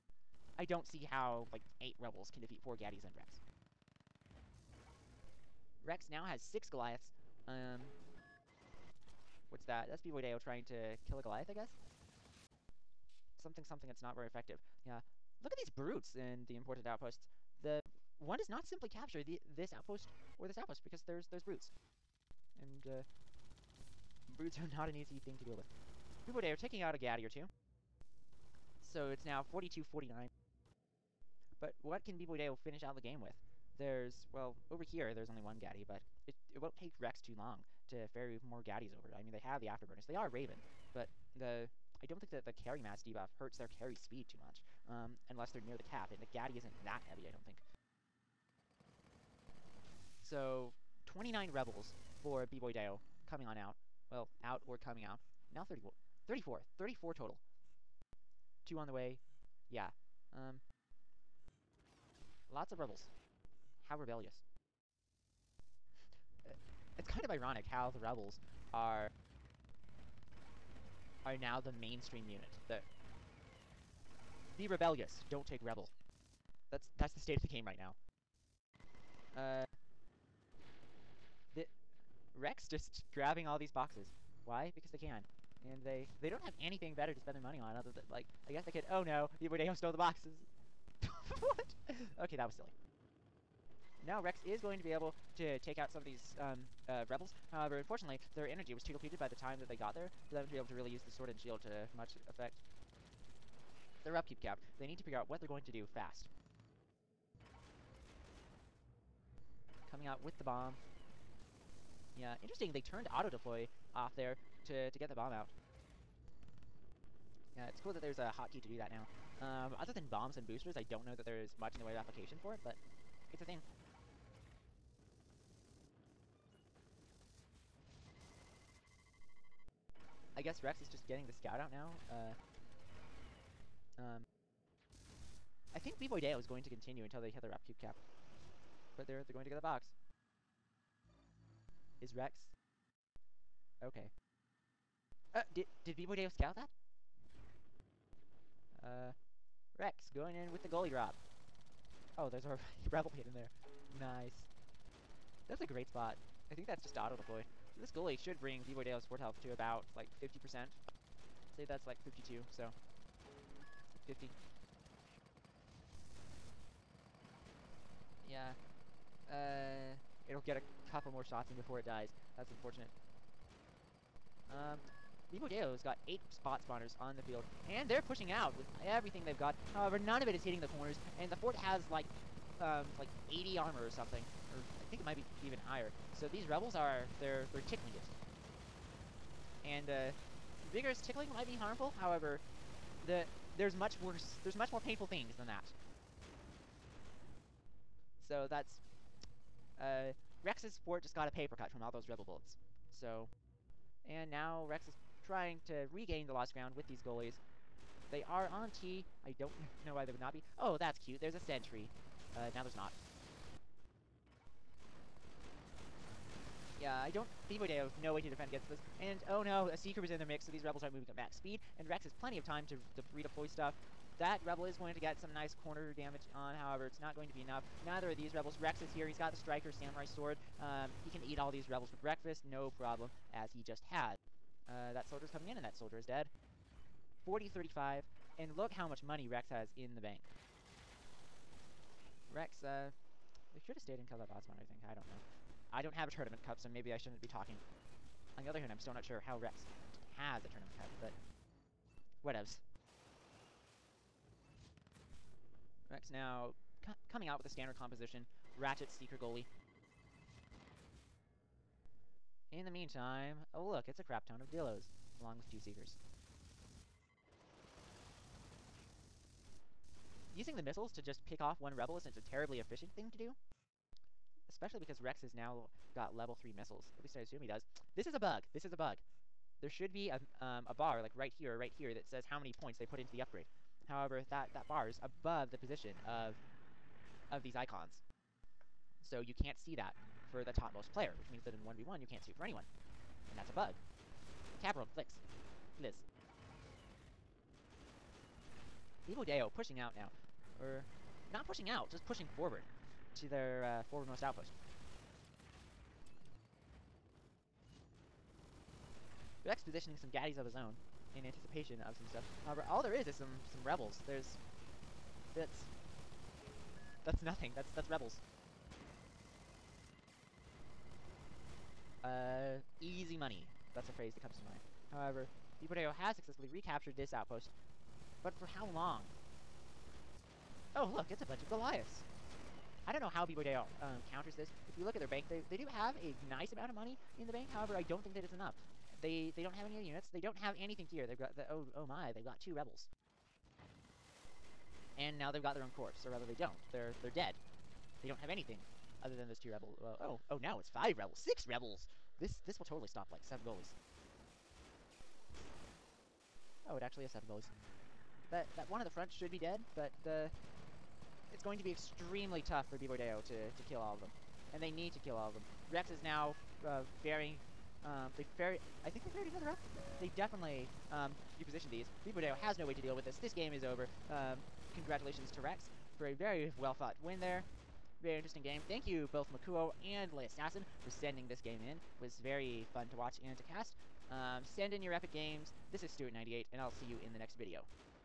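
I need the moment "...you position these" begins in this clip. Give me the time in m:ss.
6:11.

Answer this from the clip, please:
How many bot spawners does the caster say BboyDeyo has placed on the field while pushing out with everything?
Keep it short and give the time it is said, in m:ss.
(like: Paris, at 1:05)
8, at 2:56.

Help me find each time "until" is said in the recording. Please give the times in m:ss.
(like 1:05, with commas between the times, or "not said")
2:17.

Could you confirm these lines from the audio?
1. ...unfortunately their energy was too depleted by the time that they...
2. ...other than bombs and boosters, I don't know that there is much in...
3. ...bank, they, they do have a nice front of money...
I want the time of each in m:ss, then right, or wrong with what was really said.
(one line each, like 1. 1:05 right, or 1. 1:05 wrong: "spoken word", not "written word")
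1. 1:37 right
2. 1:59 right
3. 5:35 wrong: "amount", not "front".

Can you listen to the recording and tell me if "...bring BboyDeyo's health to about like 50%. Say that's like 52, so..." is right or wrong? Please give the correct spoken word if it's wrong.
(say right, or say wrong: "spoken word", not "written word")
right.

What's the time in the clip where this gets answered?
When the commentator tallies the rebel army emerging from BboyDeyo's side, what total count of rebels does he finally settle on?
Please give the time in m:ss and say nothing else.
0:56.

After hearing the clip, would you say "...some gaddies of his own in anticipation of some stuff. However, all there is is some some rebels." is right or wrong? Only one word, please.
right.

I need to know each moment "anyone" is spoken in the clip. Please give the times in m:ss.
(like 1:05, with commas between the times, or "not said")
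4:52.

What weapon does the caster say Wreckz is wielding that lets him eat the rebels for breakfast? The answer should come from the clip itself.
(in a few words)
Striker Samurai Sword.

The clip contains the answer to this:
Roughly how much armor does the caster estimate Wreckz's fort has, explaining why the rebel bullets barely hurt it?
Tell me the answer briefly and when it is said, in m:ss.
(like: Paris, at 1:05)
80, at 3:03.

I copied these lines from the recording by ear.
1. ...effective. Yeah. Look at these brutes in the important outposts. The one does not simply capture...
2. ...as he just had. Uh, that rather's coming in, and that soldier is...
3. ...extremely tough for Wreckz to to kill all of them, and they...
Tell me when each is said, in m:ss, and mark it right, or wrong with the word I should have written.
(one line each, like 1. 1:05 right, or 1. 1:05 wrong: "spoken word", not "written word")
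1. 0:14 right
2. 3:53 wrong: "soldier", not "rather"
3. 6:01 wrong: "BboyDeyo", not "Wreckz".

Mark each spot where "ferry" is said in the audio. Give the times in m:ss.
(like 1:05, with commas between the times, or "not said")
0:38, 6:08.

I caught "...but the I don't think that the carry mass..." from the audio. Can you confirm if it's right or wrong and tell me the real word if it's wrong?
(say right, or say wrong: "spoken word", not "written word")
right.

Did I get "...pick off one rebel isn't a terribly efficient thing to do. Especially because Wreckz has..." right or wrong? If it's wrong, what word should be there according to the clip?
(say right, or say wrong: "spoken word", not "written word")
right.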